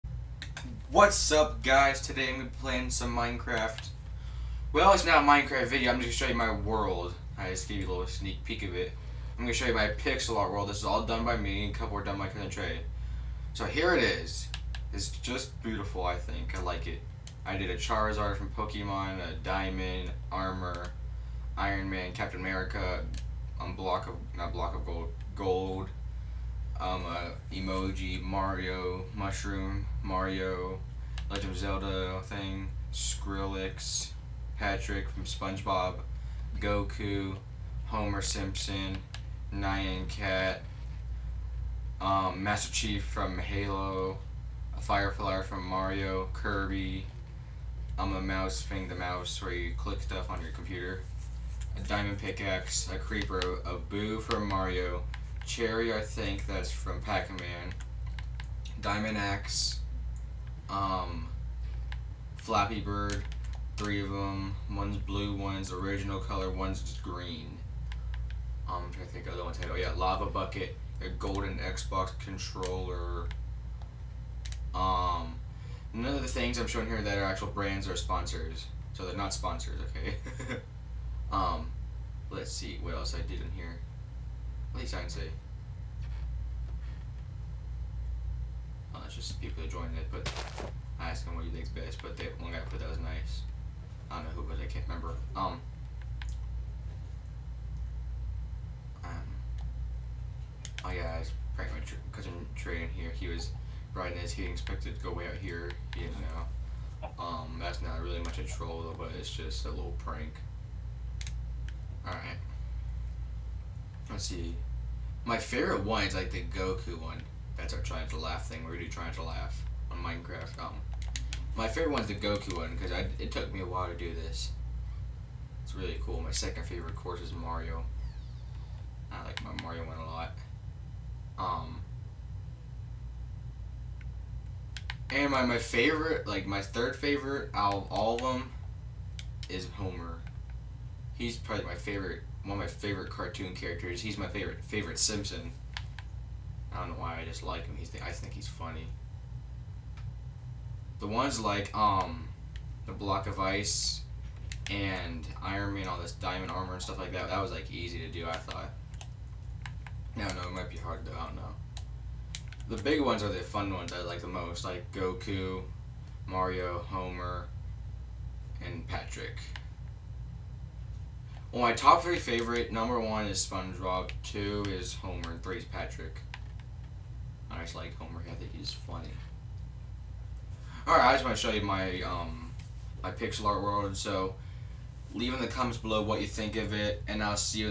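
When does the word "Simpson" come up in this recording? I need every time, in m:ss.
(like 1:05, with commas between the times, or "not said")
0:38, 2:24.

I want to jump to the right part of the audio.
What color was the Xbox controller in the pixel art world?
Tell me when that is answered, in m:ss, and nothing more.
1:11.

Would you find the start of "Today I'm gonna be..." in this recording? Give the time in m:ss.
0:02.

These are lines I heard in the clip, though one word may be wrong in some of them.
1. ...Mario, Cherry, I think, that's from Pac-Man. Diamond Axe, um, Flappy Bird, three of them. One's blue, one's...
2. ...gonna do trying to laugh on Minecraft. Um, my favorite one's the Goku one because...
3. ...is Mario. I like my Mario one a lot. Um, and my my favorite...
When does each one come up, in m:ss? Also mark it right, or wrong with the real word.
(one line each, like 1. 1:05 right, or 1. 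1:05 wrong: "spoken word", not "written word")
1. 0:54 right
2. 1:58 right
3. 2:07 right.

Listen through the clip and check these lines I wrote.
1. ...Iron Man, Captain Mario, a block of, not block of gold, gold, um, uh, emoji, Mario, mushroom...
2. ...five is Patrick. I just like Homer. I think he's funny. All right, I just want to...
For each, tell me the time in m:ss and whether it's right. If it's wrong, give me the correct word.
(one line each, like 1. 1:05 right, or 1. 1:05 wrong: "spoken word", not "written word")
1. 0:21 wrong: "America", not "Mario"
2. 2:55 wrong: "three", not "five".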